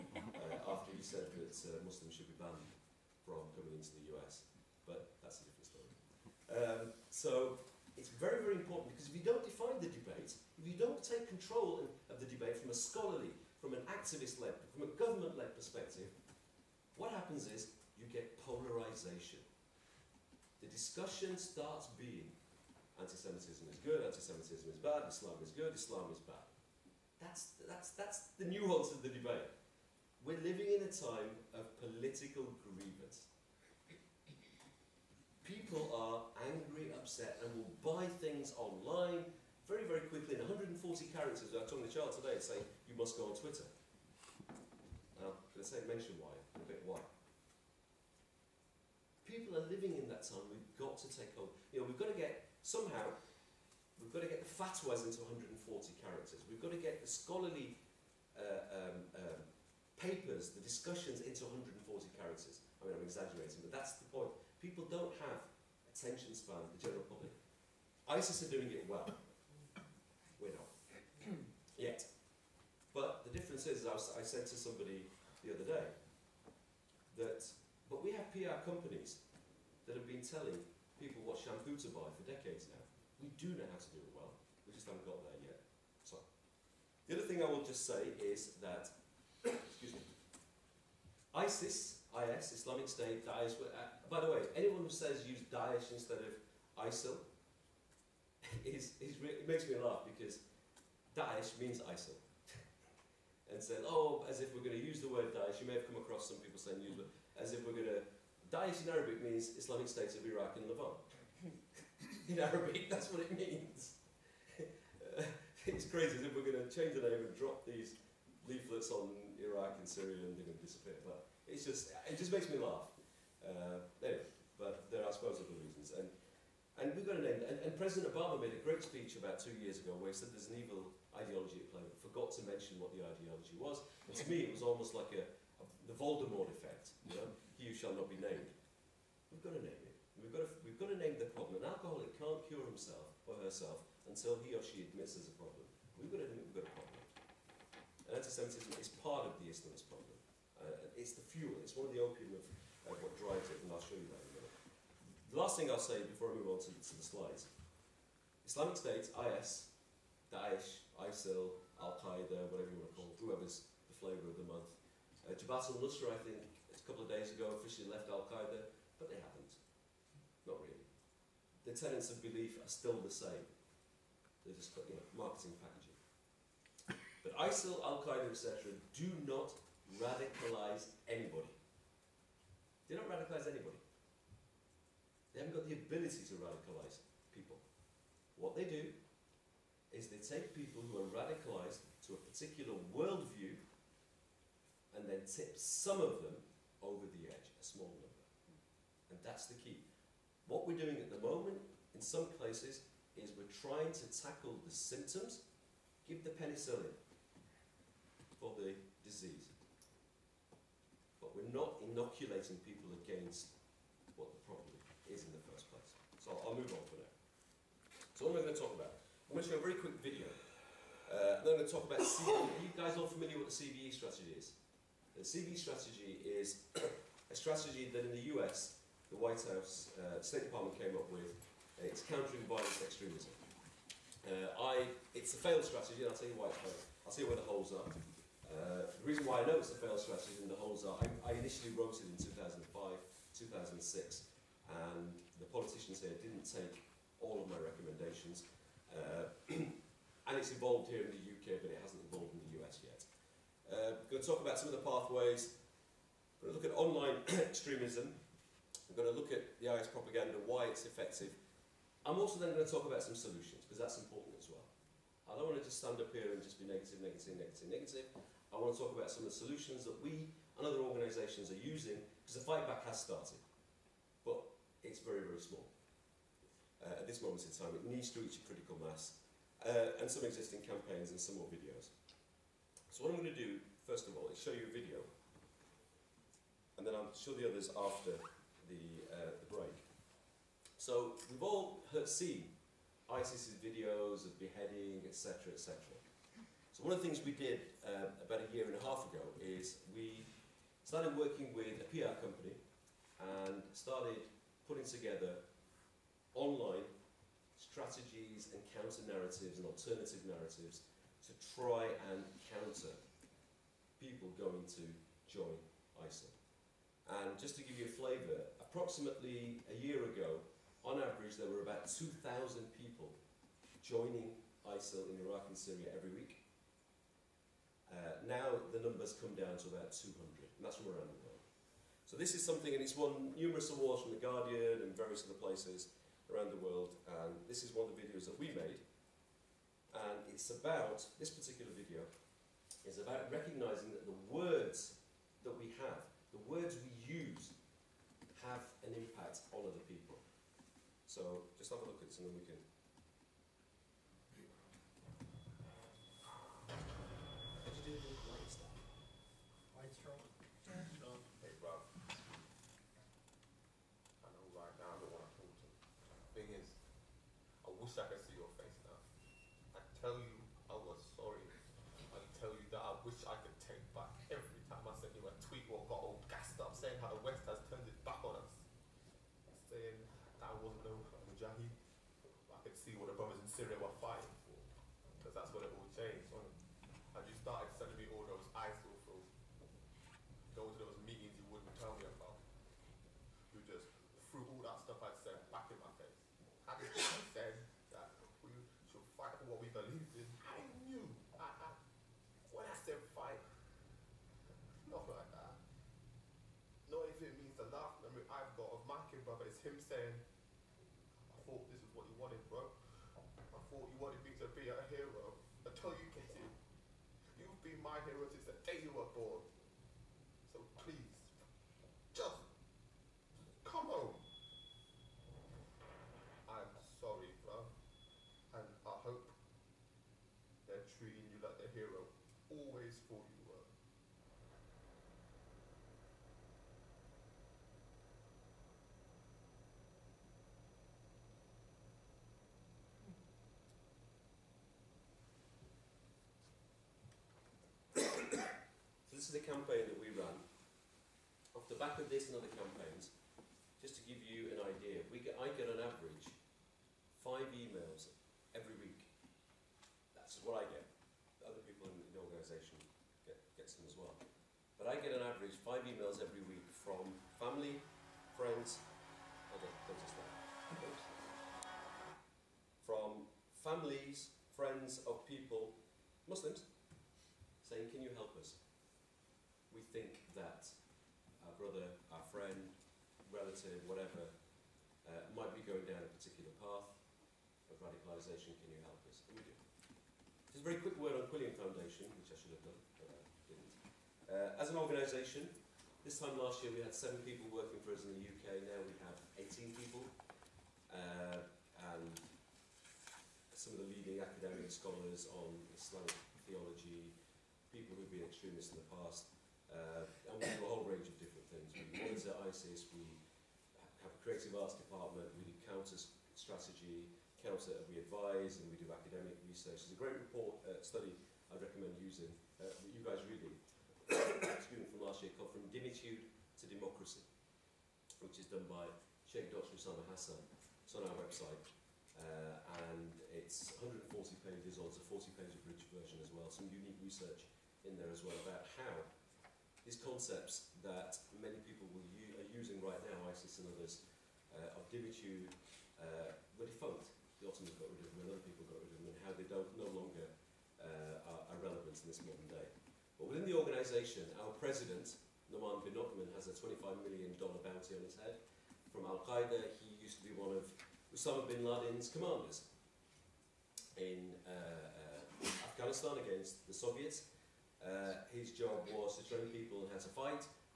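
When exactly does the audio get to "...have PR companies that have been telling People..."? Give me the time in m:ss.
1:18.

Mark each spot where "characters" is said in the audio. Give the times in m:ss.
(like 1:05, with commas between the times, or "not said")
0:41, 0:56, 1:02.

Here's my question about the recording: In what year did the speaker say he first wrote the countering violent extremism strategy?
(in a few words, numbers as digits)
2005.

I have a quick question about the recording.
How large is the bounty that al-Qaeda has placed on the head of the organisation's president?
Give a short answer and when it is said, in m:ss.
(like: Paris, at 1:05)
$25 million, at 9:16.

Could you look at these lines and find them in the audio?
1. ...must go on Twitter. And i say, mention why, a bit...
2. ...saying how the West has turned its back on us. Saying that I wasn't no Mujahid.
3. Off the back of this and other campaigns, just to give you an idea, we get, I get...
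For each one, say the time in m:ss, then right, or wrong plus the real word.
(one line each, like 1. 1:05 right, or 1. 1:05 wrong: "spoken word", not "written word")
1. 0:42 right
2. 6:16 right
3. 7:31 right.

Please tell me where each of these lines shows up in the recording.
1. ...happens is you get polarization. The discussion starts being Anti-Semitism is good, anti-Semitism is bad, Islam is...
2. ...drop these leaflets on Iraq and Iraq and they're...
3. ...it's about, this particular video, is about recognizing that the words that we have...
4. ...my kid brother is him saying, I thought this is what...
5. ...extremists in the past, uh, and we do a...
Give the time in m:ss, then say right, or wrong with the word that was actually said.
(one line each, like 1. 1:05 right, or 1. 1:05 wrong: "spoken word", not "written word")
1. 0:17 right
2. 1:57 wrong: "Syria", not "Iraq"
3. 5:40 right
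4. 6:48 right
5. 8:28 right.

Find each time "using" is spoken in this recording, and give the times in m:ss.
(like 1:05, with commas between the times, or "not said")
4:31, 8:41, 9:02.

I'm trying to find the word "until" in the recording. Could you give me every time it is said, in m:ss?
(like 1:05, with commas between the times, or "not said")
2:24, 6:55.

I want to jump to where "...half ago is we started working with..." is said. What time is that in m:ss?
4:58.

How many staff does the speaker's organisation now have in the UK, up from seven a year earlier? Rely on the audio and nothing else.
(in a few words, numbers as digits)
18.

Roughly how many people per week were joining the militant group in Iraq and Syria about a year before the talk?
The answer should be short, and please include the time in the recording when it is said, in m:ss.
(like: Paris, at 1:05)
2,000, at 5:21.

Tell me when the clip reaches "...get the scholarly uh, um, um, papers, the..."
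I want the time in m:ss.
0:56.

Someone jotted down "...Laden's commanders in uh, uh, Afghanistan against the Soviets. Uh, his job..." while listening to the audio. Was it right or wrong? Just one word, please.
right.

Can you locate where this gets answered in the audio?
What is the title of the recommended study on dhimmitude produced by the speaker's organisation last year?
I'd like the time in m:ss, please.
8:45.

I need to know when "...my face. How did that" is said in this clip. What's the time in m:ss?
6:35.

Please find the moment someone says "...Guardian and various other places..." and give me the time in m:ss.
5:34.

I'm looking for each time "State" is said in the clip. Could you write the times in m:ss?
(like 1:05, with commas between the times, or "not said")
1:32, 1:49, 2:38, 3:50.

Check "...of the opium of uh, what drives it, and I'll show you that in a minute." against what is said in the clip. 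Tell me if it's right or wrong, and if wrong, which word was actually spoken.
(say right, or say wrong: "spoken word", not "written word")
right.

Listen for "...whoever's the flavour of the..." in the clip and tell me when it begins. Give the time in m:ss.
2:43.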